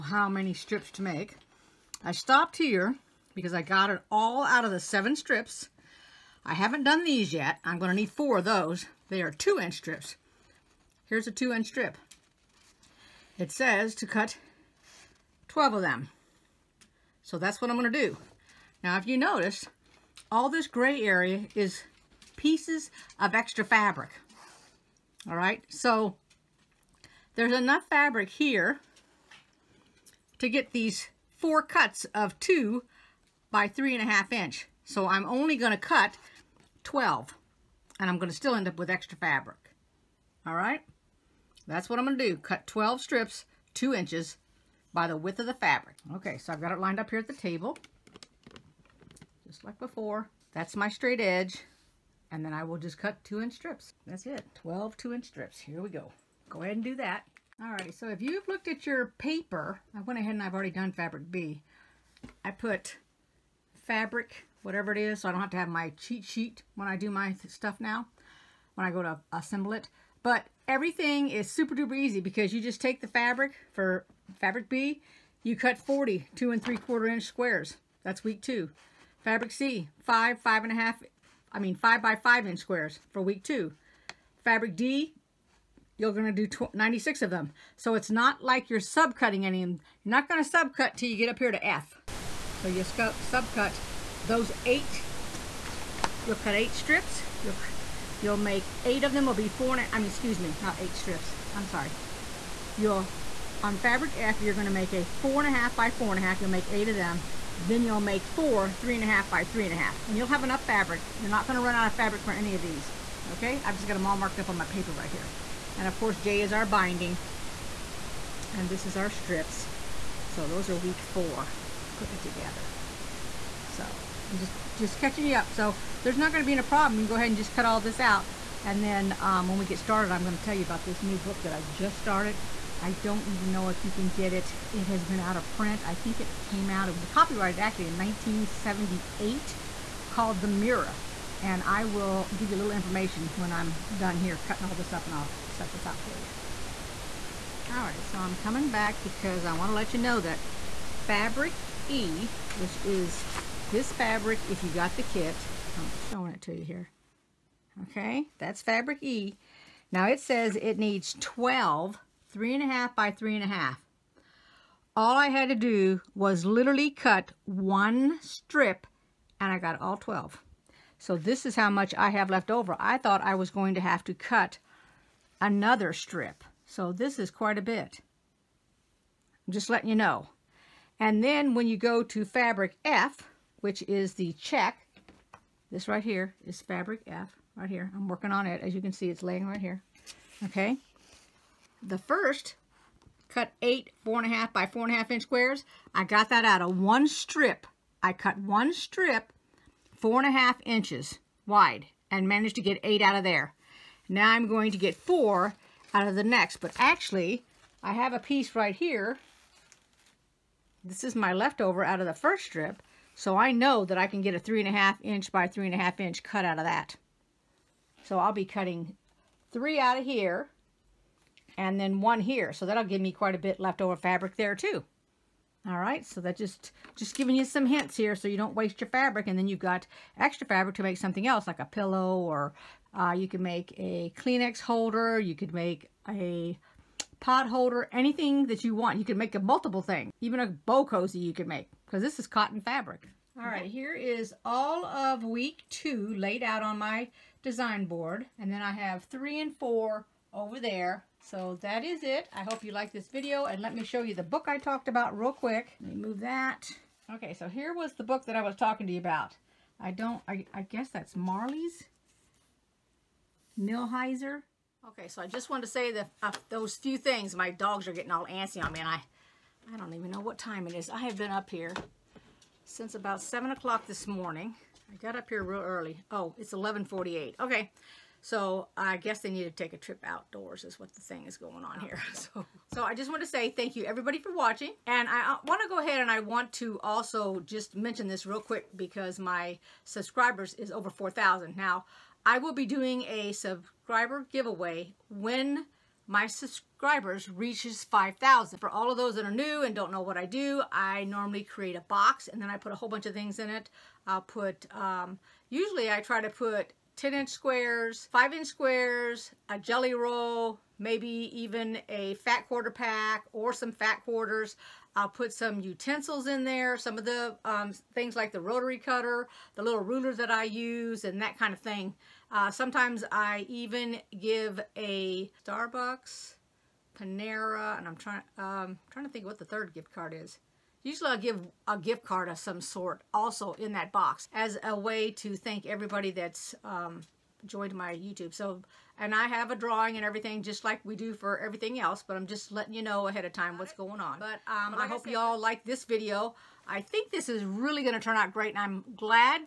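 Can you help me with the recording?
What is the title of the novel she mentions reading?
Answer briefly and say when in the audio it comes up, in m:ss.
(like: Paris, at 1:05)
The Mirror, at 2:20.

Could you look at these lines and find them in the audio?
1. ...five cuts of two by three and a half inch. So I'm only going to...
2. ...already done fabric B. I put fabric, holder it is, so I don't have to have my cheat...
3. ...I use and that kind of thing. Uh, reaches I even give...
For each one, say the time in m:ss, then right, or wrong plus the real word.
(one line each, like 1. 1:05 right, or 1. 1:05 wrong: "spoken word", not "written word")
1. 0:31 wrong: "four", not "five"
2. 1:00 wrong: "whatever", not "holder"
3. 5:20 wrong: "sometimes", not "reaches".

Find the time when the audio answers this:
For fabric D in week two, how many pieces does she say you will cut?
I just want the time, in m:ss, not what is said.
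1:25.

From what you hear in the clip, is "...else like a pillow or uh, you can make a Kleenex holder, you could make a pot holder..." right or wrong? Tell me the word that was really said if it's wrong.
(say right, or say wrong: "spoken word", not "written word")
right.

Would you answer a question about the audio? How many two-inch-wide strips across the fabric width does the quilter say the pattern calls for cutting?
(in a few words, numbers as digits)
12.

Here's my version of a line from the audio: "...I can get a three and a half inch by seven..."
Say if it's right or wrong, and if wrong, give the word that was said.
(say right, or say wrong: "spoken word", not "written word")
wrong: "three", not "seven".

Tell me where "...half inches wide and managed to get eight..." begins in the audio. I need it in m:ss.
3:20.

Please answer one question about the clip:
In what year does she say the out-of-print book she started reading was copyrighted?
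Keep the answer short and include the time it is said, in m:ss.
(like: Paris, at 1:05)
1978, at 2:17.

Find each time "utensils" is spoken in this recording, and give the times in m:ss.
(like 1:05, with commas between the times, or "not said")
5:15.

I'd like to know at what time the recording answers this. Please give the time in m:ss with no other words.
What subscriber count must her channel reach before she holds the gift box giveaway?
4:57.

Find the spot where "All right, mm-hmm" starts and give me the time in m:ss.
4:03.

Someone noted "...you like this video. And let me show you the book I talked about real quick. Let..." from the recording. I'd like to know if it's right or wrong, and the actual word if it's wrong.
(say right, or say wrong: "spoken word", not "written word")
right.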